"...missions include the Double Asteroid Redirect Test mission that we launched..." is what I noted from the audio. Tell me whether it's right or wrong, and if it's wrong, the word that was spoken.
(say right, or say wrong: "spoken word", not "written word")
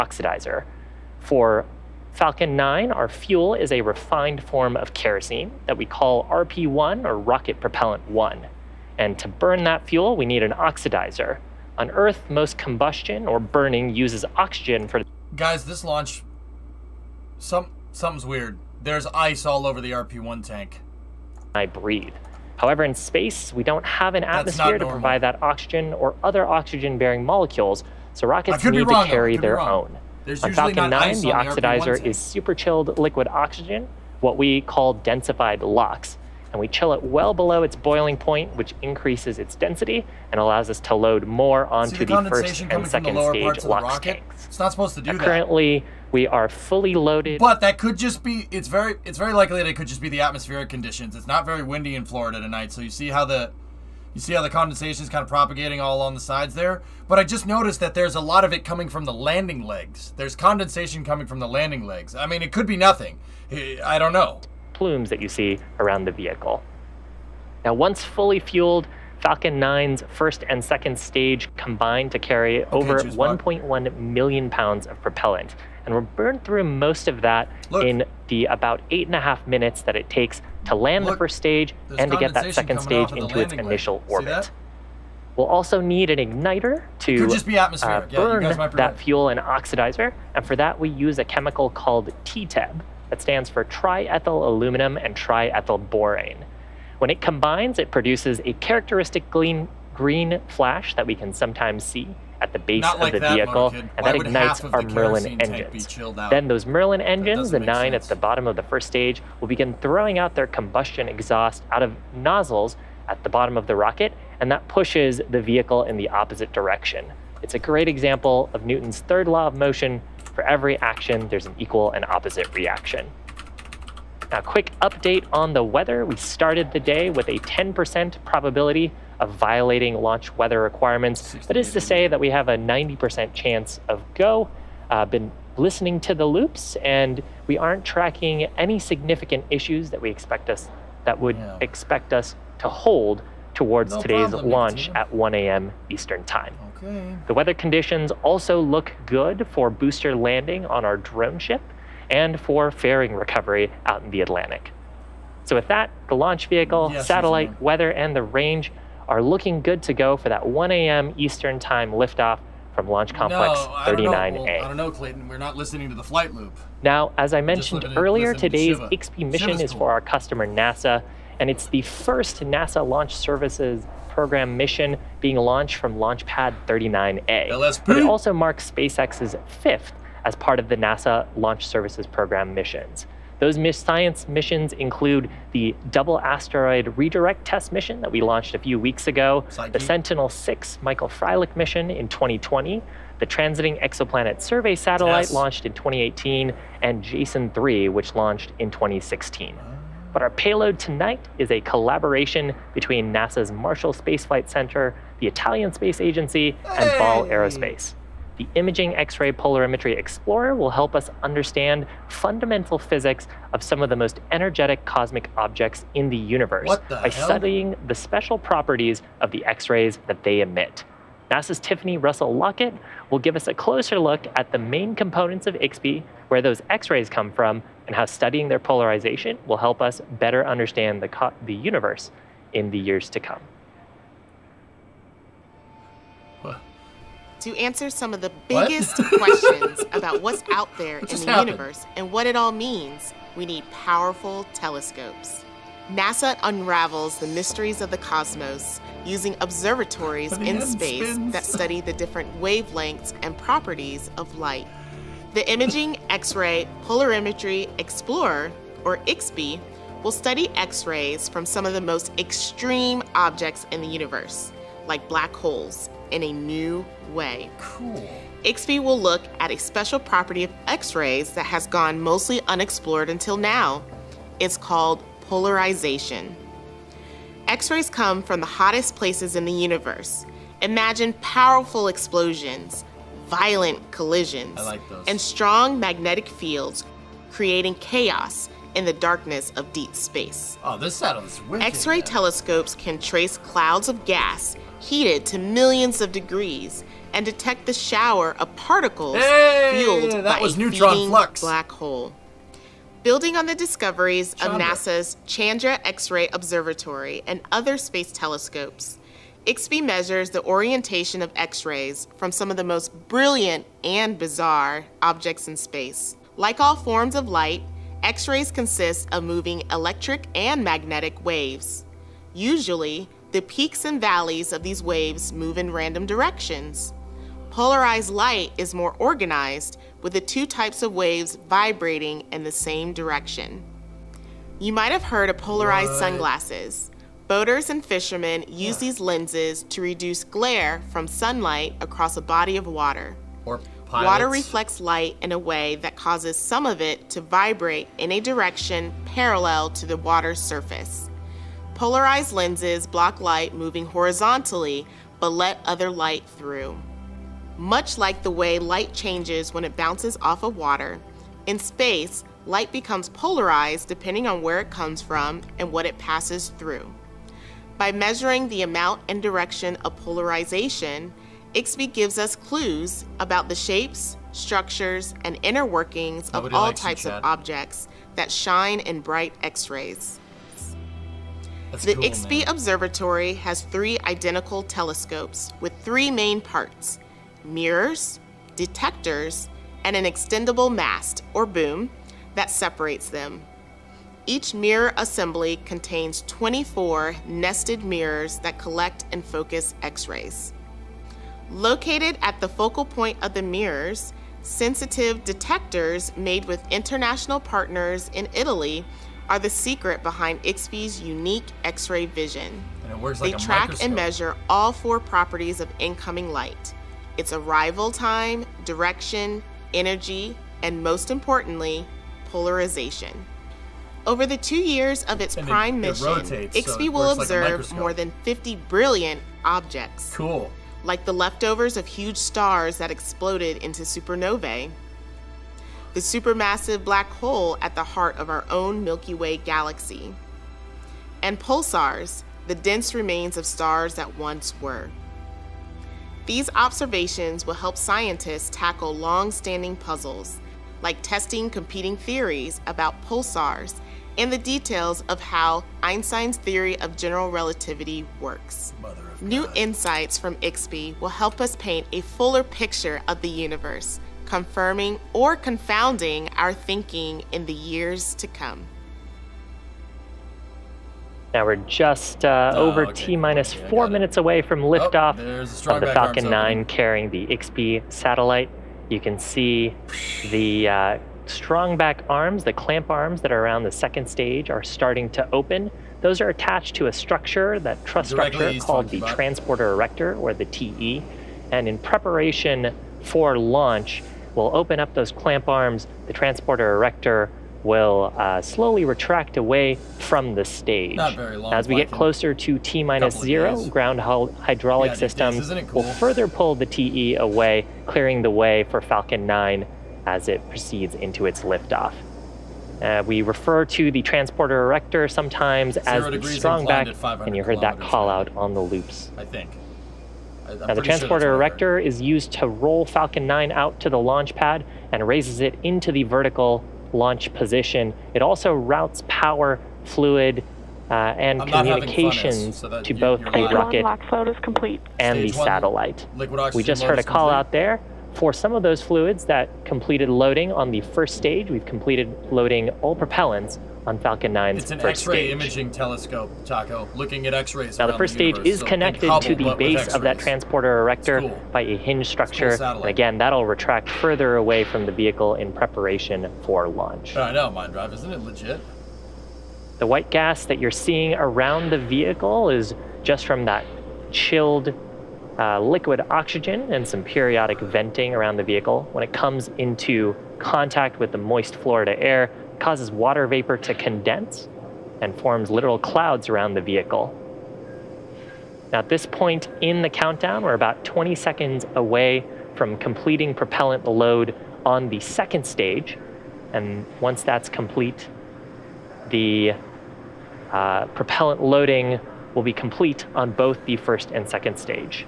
right.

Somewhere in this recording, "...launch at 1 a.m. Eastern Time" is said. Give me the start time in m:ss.
2:24.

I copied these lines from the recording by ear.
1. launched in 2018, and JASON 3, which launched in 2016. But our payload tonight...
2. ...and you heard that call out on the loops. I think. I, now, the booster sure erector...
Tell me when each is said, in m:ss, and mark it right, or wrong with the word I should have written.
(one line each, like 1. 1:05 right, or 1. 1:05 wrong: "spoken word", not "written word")
1. 3:15 right
2. 8:37 wrong: "transporter", not "booster".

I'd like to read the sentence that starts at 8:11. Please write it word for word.
And in preparation for launch, will open up those clamp arms.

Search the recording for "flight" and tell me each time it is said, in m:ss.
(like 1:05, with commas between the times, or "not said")
2:46, 3:24.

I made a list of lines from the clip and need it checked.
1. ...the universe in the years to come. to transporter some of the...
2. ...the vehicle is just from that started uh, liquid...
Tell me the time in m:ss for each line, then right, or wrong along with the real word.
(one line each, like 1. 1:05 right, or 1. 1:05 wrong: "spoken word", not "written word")
1. 3:51 wrong: "answer", not "transporter"
2. 9:21 wrong: "chilled", not "started".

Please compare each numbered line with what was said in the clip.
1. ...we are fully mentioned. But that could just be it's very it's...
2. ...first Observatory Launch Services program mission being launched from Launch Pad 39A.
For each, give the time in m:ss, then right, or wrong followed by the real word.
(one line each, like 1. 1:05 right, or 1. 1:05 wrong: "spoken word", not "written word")
1. 0:46 wrong: "loaded", not "mentioned"
2. 2:51 wrong: "NASA", not "Observatory".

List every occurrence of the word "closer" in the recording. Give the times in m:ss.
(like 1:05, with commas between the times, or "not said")
3:43, 8:21.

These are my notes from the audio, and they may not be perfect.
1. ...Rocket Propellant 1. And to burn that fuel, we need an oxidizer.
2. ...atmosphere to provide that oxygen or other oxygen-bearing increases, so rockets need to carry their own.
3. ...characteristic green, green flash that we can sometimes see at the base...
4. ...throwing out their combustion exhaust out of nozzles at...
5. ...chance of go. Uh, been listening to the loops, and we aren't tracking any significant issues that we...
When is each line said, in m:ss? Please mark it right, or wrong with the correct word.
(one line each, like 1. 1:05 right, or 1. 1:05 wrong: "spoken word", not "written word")
1. 0:07 right
2. 0:24 wrong: "molecules", not "increases"
3. 1:38 right
4. 1:49 right
5. 2:13 right.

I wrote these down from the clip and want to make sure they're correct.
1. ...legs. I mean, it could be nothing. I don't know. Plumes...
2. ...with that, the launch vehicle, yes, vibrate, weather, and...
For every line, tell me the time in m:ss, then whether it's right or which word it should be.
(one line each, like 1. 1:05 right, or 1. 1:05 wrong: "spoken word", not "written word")
1. 1:01 right
2. 2:35 wrong: "satellite", not "vibrate".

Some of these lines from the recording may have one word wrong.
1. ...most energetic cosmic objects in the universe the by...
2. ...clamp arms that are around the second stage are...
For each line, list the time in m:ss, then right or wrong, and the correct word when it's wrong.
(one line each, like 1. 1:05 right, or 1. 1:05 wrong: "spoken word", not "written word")
1. 3:33 right
2. 8:02 right.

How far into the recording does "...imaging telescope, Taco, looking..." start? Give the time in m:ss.
9:05.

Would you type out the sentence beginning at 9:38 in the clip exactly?
Now, at this point in the countdown, we're about 20 seconds away from completing propellant load on the second stage.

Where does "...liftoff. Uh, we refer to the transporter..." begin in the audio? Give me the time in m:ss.
8:31.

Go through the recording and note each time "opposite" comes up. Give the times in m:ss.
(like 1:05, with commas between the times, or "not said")
1:56, 2:02.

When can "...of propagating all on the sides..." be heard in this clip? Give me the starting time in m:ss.
0:55.